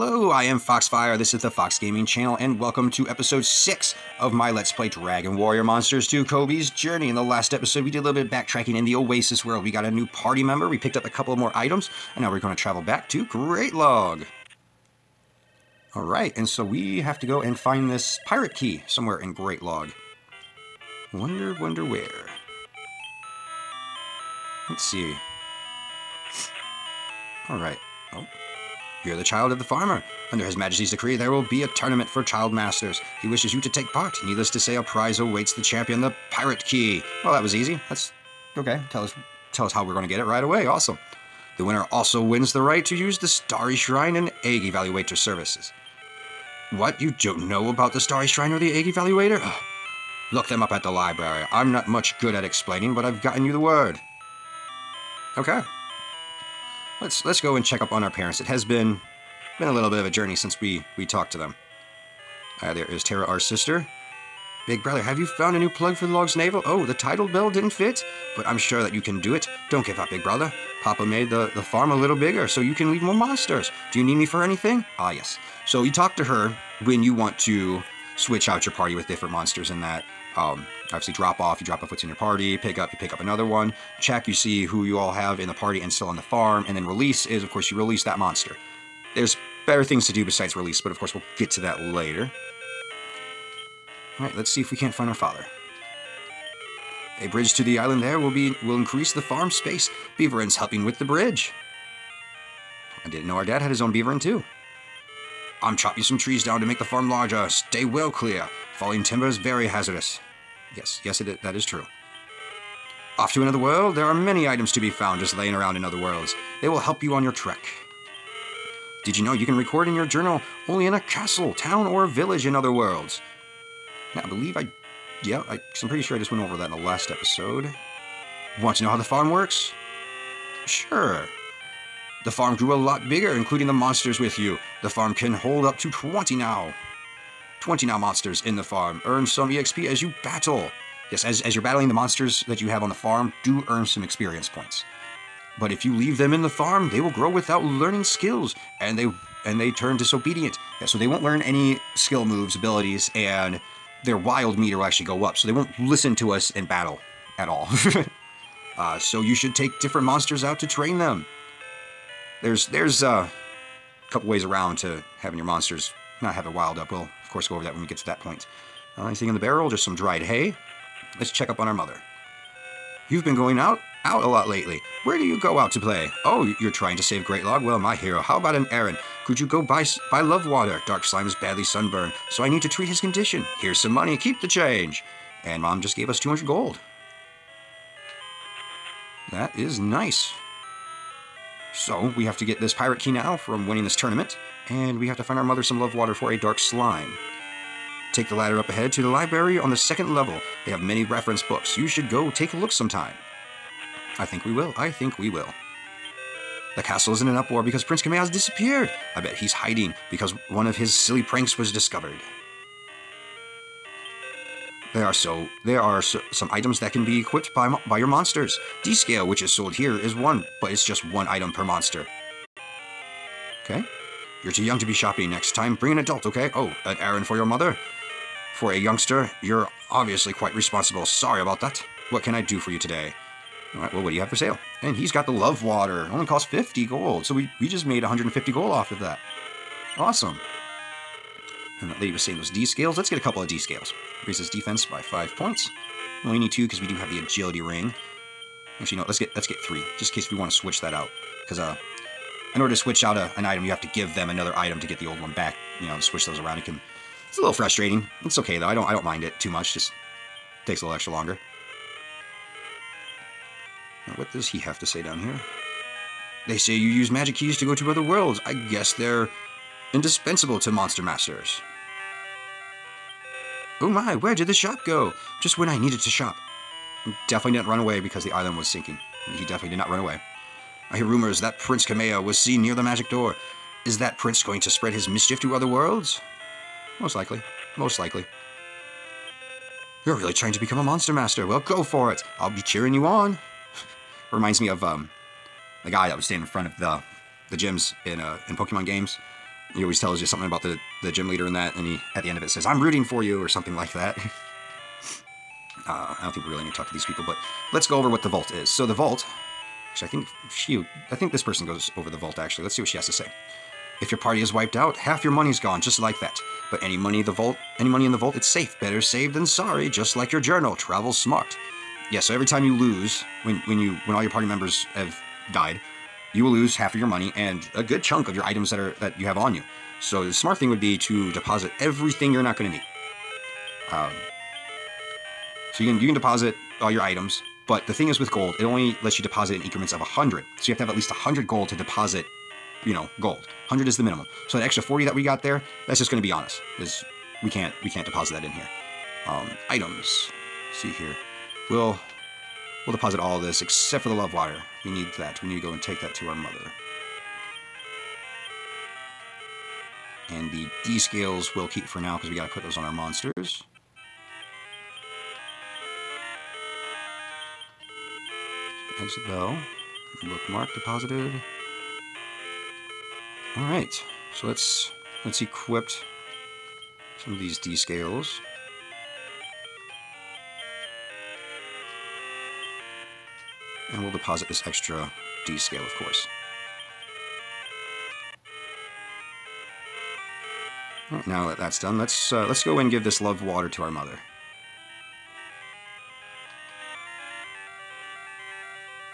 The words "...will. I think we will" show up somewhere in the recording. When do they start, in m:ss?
3:24.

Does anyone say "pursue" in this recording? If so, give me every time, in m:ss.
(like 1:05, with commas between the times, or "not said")
not said.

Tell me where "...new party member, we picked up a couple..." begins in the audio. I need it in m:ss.
0:09.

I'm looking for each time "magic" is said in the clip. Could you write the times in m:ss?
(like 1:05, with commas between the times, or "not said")
4:27, 4:42.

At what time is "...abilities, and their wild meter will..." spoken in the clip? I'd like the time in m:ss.
2:32.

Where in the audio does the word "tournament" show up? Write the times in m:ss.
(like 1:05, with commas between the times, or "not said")
0:31, 3:13.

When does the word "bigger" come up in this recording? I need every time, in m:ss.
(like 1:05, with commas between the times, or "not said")
1:12, 2:13.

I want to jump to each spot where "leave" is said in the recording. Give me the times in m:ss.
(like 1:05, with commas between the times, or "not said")
1:12, 2:25.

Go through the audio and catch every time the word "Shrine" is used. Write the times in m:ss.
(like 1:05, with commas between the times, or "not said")
0:43, 0:48.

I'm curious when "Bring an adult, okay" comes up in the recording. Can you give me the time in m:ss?
3:45.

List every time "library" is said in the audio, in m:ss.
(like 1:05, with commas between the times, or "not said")
0:50, 3:19.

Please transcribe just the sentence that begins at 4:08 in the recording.
Actually, no, let's get let's get 3.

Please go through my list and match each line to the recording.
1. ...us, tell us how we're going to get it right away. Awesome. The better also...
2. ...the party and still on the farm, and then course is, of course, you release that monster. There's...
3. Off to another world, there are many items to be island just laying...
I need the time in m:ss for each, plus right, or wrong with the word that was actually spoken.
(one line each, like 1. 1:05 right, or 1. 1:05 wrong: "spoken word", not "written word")
1. 0:39 wrong: "winner", not "better"
2. 1:25 wrong: "release", not "course"
3. 1:53 wrong: "found", not "island".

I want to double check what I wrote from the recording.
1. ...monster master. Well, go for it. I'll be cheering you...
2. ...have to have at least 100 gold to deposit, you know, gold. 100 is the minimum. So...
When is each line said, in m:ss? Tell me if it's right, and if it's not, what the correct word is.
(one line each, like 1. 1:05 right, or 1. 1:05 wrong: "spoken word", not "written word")
1. 4:50 right
2. 5:40 right.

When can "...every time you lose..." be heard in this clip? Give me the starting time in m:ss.
5:22.